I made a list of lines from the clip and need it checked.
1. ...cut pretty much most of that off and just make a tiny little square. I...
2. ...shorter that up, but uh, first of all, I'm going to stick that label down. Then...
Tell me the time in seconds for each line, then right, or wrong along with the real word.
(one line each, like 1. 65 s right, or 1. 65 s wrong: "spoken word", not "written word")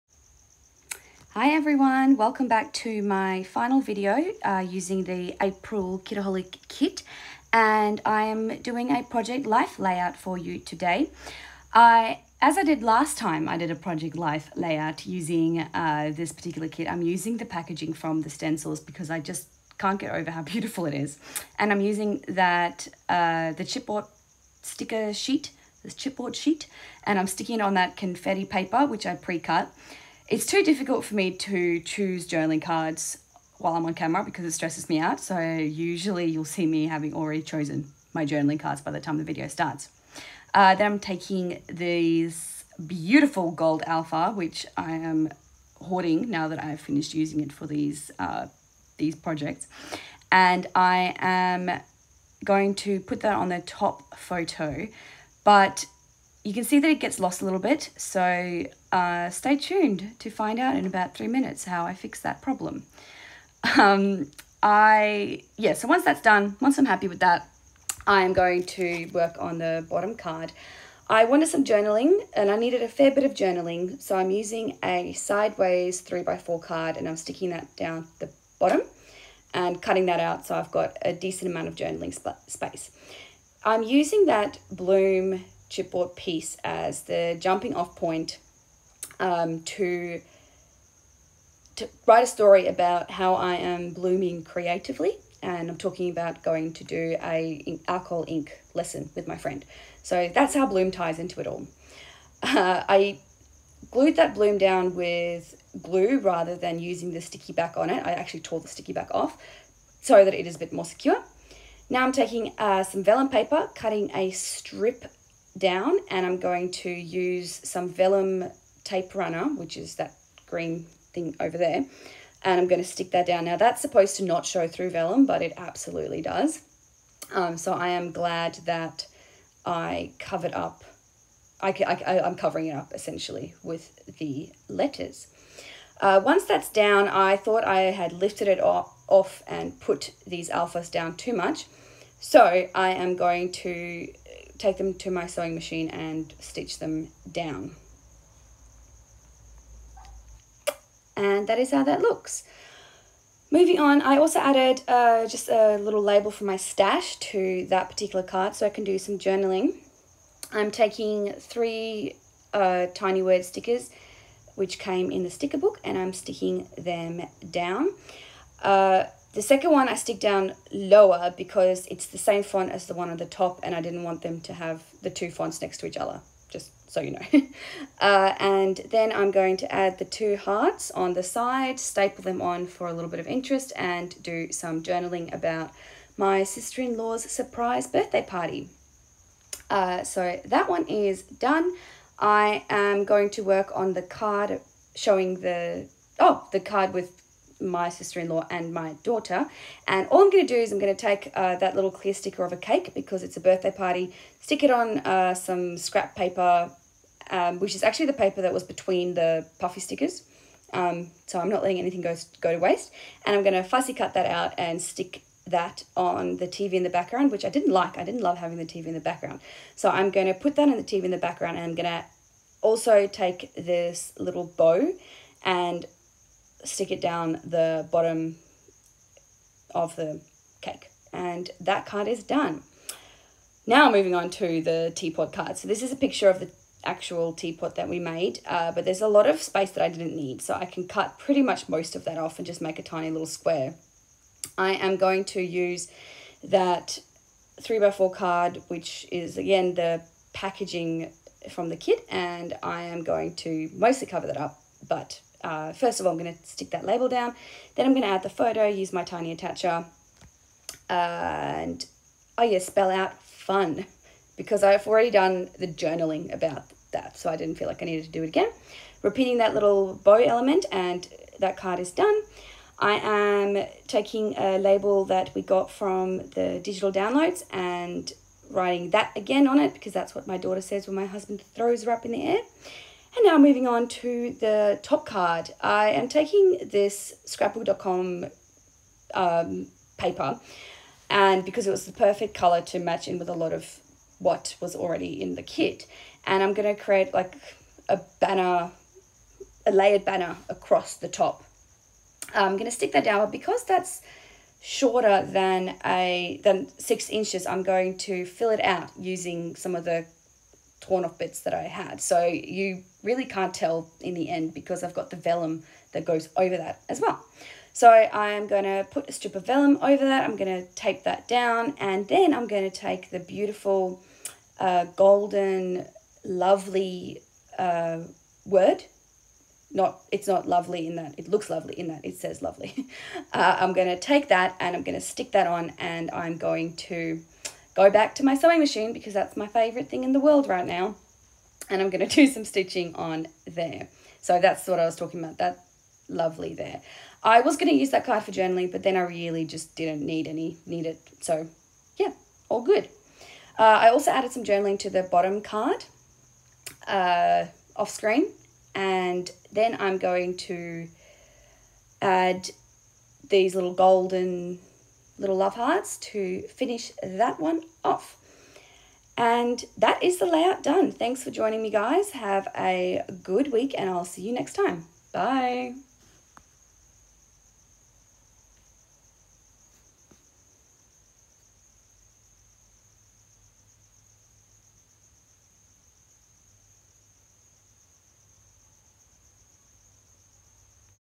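1. 240 s right
2. 254 s wrong: "cover", not "shorter".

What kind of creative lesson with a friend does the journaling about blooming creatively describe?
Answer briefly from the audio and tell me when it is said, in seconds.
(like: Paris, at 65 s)
alcohol ink lesson, at 97 s.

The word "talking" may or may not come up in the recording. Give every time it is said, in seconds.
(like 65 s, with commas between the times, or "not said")
95 s, 344 s.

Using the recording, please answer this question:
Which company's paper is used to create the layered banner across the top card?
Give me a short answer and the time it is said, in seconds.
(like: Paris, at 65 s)
Scrapbook.com, at 287 s.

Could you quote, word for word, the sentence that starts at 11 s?
I, as I did last time, I did a project life layout using uh, this particular kit.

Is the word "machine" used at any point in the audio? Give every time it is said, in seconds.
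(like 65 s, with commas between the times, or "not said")
145 s, 338 s.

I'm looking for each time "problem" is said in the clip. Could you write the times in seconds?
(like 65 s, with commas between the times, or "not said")
62 s.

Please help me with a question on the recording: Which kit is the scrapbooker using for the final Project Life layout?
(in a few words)
April Kitaholic kit.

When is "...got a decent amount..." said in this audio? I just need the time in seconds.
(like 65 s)
80 s.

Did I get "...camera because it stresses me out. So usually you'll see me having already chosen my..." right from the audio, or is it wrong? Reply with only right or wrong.
right.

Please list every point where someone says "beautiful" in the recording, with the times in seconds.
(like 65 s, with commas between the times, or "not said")
20 s, 42 s, 323 s.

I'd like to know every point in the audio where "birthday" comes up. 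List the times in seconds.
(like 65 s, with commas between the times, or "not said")
187 s, 203 s.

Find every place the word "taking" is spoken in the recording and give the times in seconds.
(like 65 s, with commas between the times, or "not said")
40 s, 112 s, 160 s, 273 s, 286 s.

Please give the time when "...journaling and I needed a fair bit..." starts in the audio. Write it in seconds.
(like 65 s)
71 s.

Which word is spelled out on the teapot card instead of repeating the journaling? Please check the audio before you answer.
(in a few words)
fun.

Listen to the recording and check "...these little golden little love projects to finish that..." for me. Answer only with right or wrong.
wrong.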